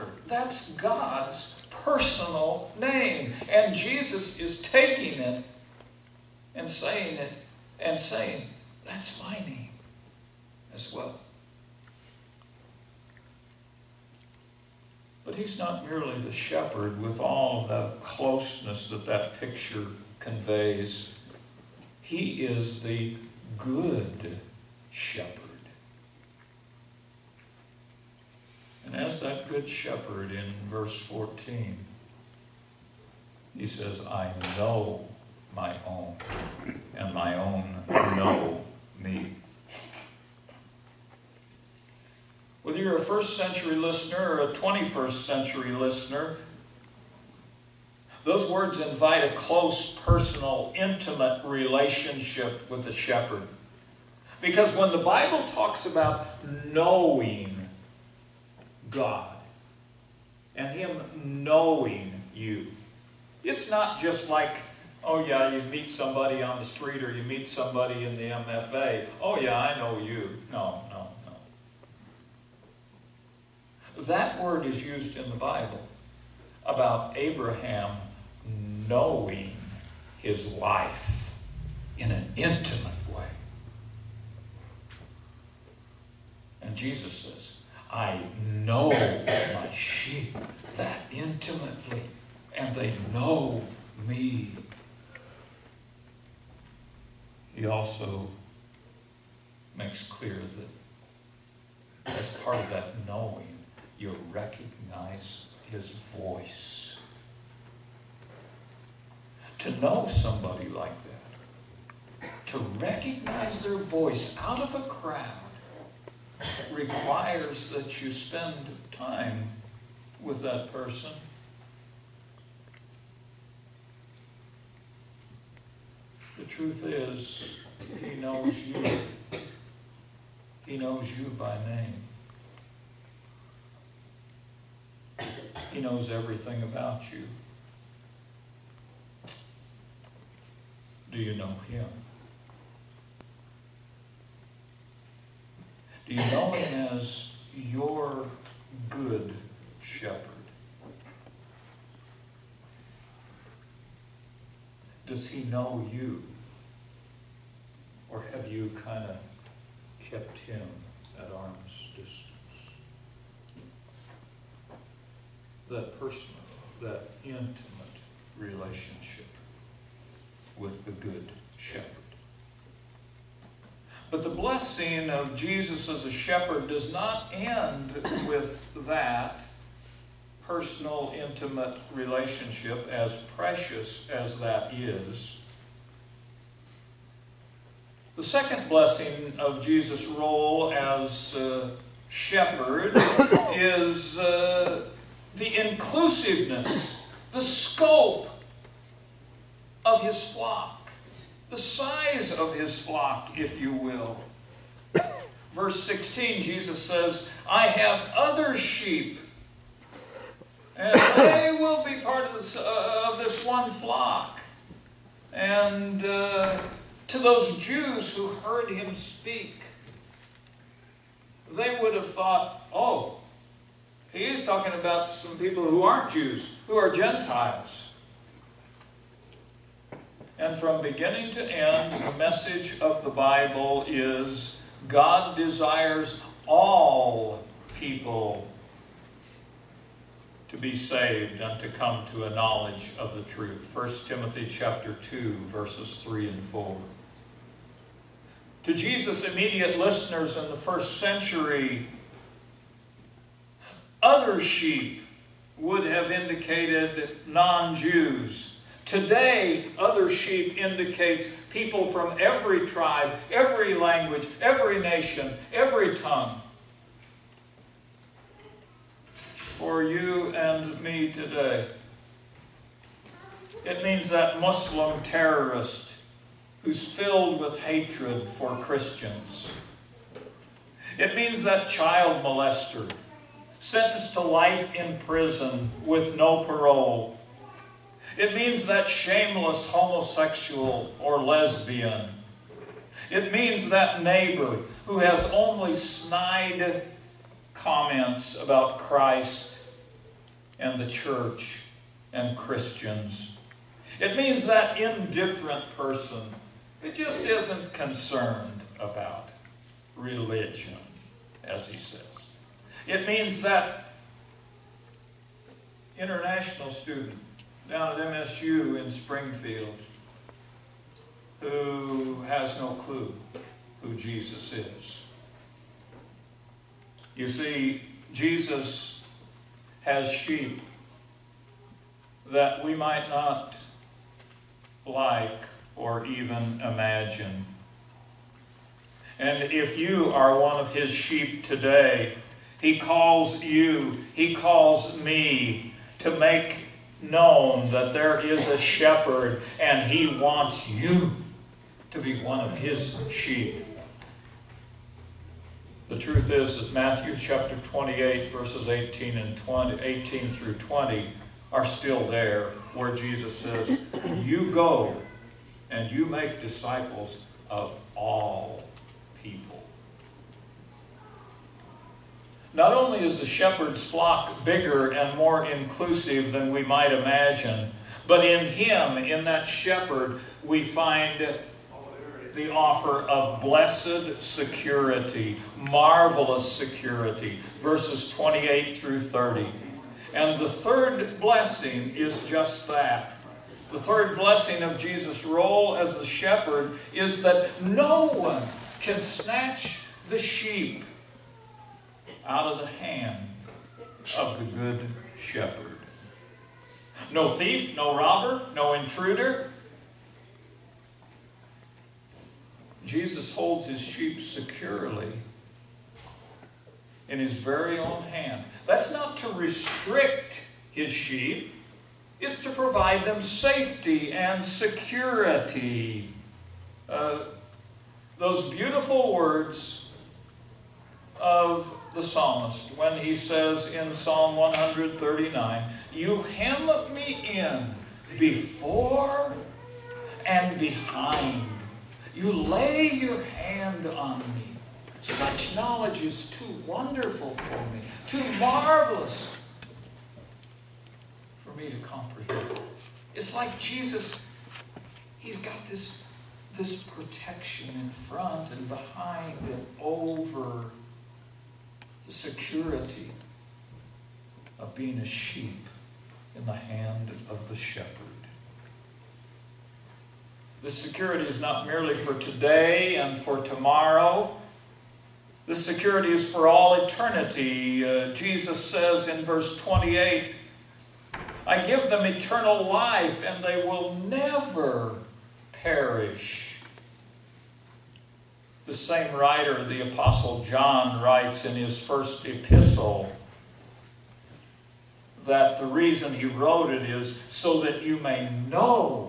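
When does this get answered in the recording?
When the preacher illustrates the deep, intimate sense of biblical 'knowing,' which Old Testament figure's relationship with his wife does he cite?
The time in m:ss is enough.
1:17.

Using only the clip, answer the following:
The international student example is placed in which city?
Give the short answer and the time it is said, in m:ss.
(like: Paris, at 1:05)
Springfield, at 5:18.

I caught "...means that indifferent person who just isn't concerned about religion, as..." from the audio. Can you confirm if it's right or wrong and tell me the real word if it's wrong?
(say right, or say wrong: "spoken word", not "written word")
right.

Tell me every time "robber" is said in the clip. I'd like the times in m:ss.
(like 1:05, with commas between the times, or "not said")
6:47.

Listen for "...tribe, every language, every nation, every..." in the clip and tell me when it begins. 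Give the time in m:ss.
4:22.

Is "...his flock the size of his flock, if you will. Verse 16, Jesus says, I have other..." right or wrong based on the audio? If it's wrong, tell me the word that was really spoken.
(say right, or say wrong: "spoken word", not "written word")
right.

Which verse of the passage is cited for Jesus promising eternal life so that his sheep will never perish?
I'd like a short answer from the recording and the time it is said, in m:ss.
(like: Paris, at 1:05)
Verse 28, at 7:59.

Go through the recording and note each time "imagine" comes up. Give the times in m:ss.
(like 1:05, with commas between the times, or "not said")
5:36, 6:16.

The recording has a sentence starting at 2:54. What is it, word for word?
But the blessing of Jesus as a shepherd does not end with that personal, intimate relationship, as precious as that is.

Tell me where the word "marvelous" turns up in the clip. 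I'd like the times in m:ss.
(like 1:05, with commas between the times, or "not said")
6:25, 7:28.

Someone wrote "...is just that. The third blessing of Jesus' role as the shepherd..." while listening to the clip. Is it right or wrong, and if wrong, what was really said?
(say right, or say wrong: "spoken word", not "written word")
right.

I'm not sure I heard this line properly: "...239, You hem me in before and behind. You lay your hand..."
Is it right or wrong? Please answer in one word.
wrong.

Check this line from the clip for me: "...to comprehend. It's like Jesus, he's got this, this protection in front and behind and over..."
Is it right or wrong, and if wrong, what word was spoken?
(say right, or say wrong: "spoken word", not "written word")
right.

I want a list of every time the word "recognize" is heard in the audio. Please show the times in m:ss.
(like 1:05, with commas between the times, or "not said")
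1:44, 1:52.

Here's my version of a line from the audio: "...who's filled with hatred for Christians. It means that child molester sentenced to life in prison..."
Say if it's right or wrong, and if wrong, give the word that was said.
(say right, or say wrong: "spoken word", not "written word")
right.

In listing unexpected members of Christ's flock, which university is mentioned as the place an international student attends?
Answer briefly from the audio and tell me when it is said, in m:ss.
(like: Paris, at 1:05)
MSU, at 5:18.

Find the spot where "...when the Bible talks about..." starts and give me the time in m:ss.
0:54.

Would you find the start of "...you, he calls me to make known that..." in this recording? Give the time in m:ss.
5:43.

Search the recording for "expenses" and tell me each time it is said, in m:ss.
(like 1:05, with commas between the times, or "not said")
not said.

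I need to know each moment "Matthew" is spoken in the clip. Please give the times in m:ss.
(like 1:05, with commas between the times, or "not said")
5:56.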